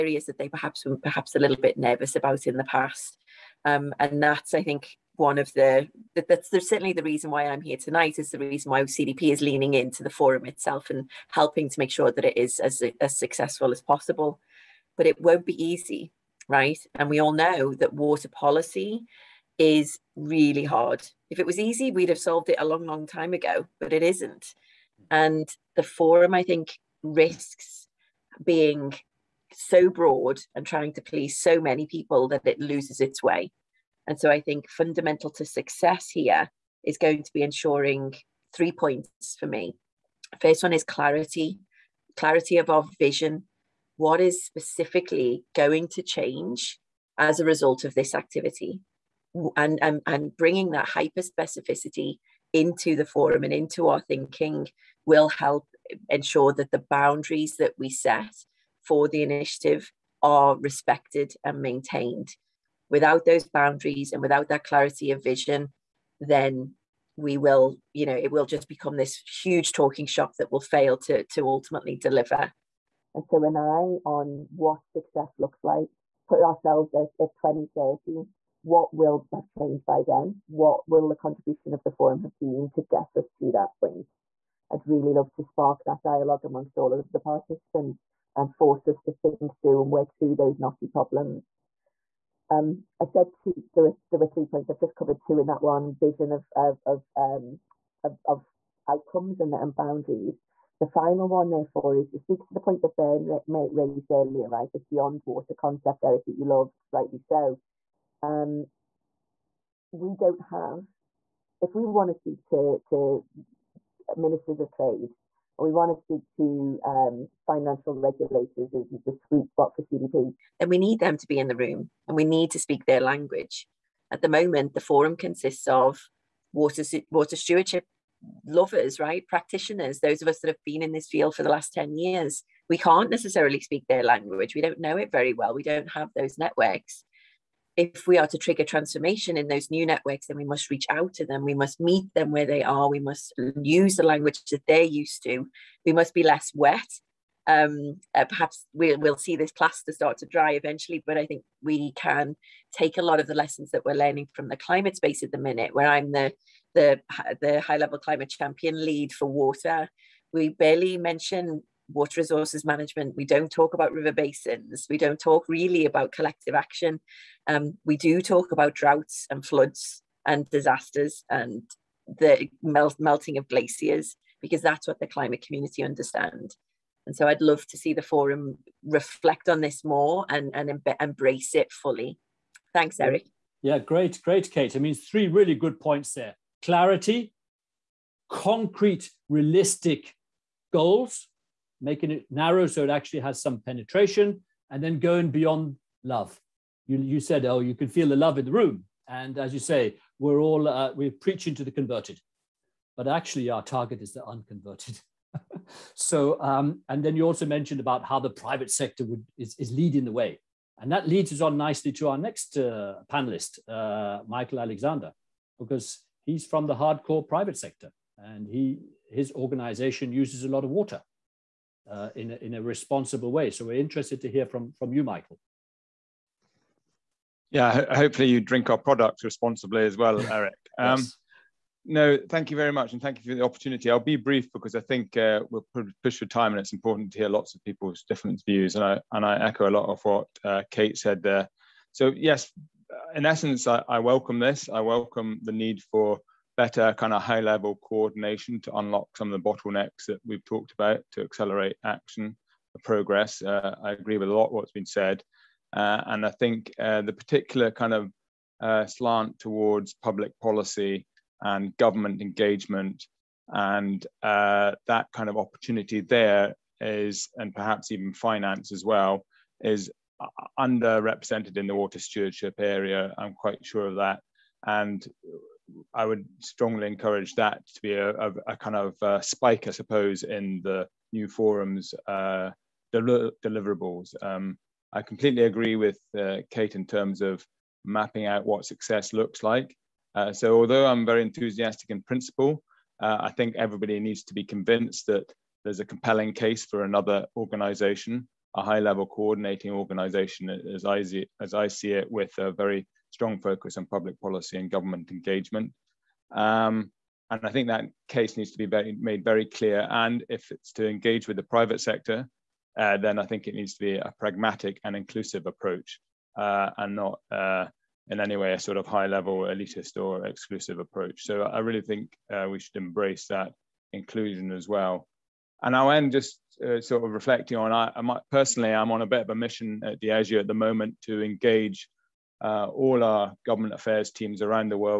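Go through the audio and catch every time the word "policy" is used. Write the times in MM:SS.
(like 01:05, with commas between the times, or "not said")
00:18, 04:20, 05:04.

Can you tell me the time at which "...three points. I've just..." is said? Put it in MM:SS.
01:34.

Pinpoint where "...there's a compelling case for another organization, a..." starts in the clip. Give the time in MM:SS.
04:55.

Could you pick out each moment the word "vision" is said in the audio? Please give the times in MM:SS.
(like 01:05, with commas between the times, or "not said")
00:42, 01:05, 01:35.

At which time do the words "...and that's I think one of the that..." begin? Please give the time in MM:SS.
00:03.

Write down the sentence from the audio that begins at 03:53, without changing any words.
I'll be brief because I think uh, we'll push for time, and it's important to hear lots of people's different views.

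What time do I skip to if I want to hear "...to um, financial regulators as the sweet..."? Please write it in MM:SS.
01:56.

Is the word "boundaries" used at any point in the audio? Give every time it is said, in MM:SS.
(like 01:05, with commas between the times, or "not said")
00:56, 01:03, 01:39.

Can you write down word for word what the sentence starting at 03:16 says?
You, you said, oh, you can feel the love in the room.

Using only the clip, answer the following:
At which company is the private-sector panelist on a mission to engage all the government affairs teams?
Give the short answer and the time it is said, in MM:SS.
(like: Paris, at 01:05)
Diageo, at 05:30.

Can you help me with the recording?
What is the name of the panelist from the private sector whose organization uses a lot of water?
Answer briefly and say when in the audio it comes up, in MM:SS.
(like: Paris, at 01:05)
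Michael Alexander, at 03:34.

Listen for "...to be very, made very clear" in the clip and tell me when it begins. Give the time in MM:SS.
05:08.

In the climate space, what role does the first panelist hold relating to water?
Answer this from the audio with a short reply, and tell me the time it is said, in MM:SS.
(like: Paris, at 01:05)
high level climate champion lead for water, at 02:37.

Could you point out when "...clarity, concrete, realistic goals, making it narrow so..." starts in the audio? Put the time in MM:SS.
03:06.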